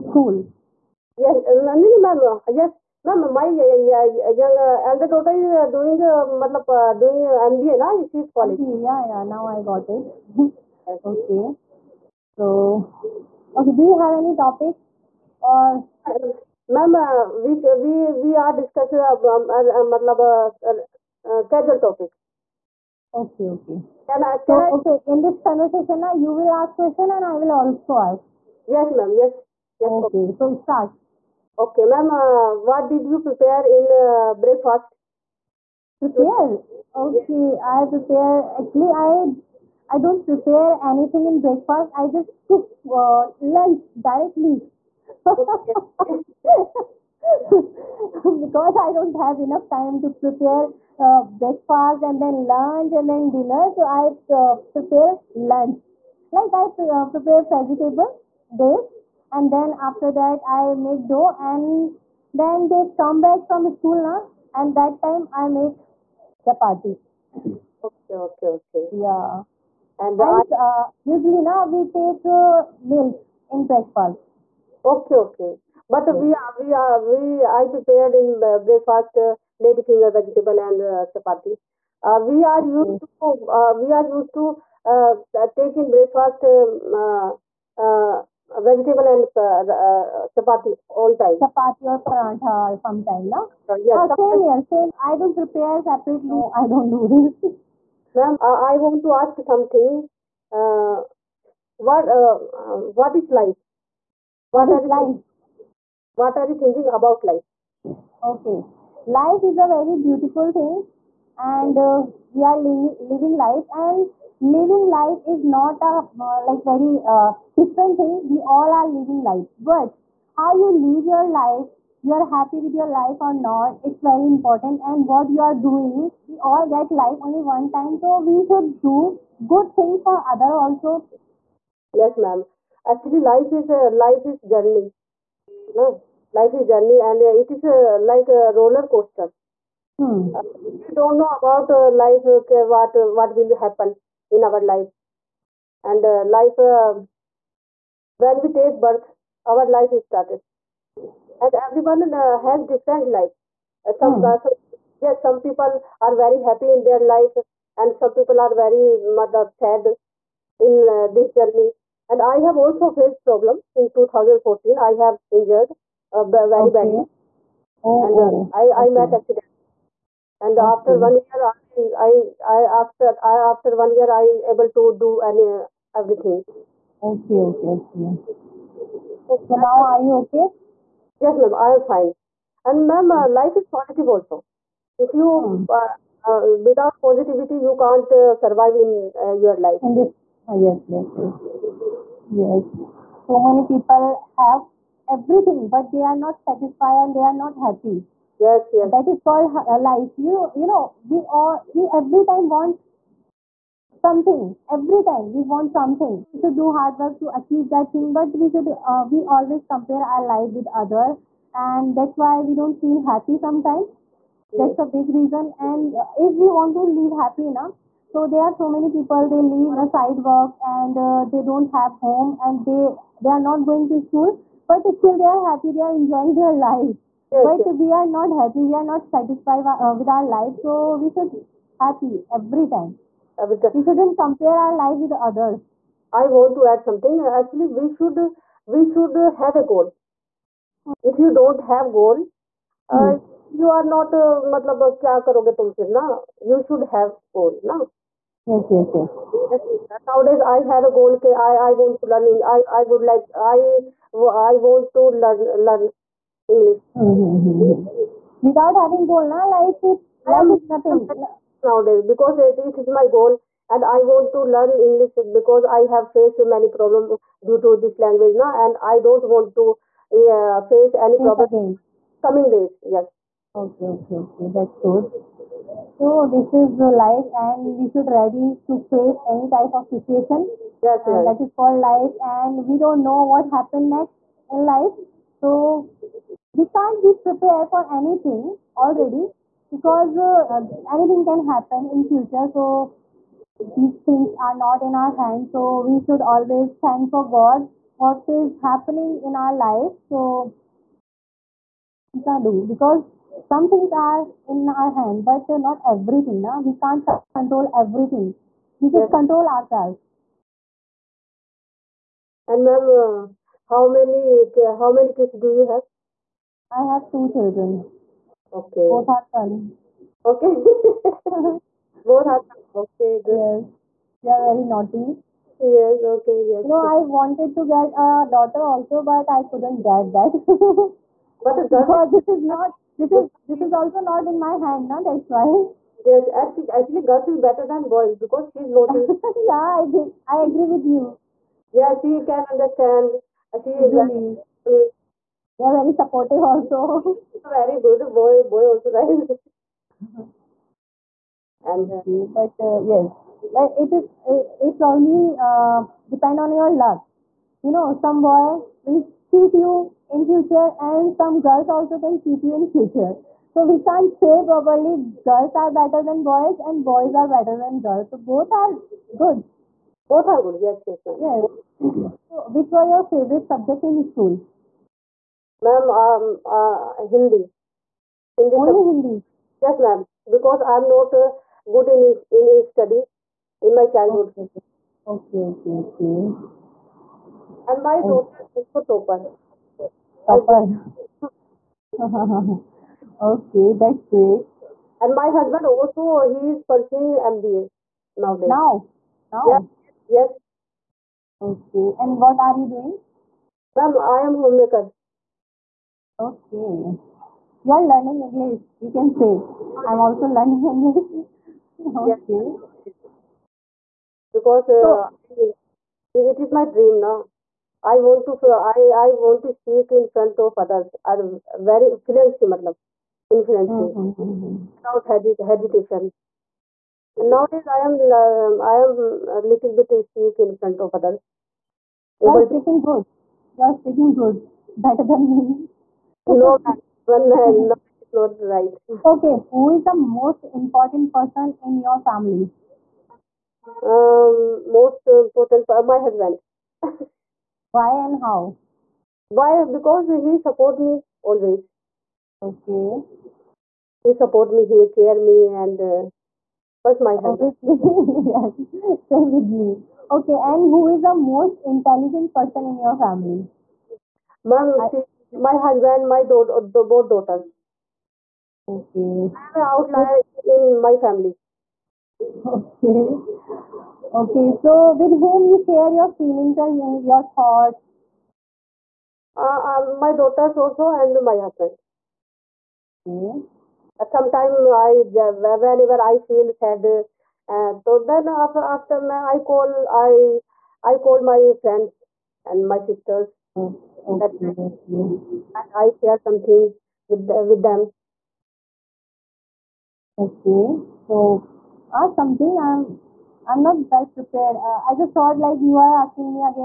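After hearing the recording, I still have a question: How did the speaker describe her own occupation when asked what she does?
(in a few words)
homemaker.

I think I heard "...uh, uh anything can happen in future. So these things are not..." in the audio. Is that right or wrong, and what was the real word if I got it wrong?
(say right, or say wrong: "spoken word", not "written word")
right.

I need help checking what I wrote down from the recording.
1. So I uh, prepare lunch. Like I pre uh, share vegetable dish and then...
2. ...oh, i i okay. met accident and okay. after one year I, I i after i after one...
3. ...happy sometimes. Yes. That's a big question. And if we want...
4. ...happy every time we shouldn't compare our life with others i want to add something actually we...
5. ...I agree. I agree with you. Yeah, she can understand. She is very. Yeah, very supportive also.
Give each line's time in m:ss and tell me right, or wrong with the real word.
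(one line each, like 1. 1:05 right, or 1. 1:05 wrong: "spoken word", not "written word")
1. 0:53 wrong: "prepare", not "share"
2. 2:48 right
3. 3:33 wrong: "reason", not "question"
4. 3:51 right
5. 5:39 right.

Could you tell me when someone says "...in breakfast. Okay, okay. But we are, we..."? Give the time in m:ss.
1:13.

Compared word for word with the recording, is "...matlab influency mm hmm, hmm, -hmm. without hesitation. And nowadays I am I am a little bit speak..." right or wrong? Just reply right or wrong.
right.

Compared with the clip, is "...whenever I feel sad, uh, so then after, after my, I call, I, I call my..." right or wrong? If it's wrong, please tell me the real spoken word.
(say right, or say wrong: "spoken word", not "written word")
right.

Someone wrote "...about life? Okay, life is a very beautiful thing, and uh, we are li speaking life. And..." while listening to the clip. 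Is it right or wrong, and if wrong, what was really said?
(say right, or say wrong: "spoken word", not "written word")
wrong: "living", not "speaking".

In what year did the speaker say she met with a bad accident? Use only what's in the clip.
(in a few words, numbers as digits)
2014.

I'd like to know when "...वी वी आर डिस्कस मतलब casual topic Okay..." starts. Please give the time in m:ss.
0:17.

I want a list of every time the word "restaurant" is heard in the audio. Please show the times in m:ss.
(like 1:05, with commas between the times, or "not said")
not said.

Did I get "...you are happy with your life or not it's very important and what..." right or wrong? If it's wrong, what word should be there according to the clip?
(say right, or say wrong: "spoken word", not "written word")
right.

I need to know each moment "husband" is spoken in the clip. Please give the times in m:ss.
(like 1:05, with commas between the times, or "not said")
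6:35, 7:26, 7:37, 7:45, 8:01.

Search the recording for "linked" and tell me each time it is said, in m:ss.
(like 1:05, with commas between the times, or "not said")
not said.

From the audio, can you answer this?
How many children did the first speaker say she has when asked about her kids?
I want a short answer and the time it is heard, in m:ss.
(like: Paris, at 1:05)
2, at 5:17.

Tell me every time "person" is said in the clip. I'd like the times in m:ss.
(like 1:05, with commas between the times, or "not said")
7:21, 7:42.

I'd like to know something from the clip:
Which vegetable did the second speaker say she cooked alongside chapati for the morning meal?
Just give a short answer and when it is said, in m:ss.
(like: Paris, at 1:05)
lady finger, at 1:19.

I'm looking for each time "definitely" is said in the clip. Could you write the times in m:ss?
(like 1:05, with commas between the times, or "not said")
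not said.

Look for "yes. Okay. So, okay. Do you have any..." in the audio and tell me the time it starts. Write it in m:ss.
0:10.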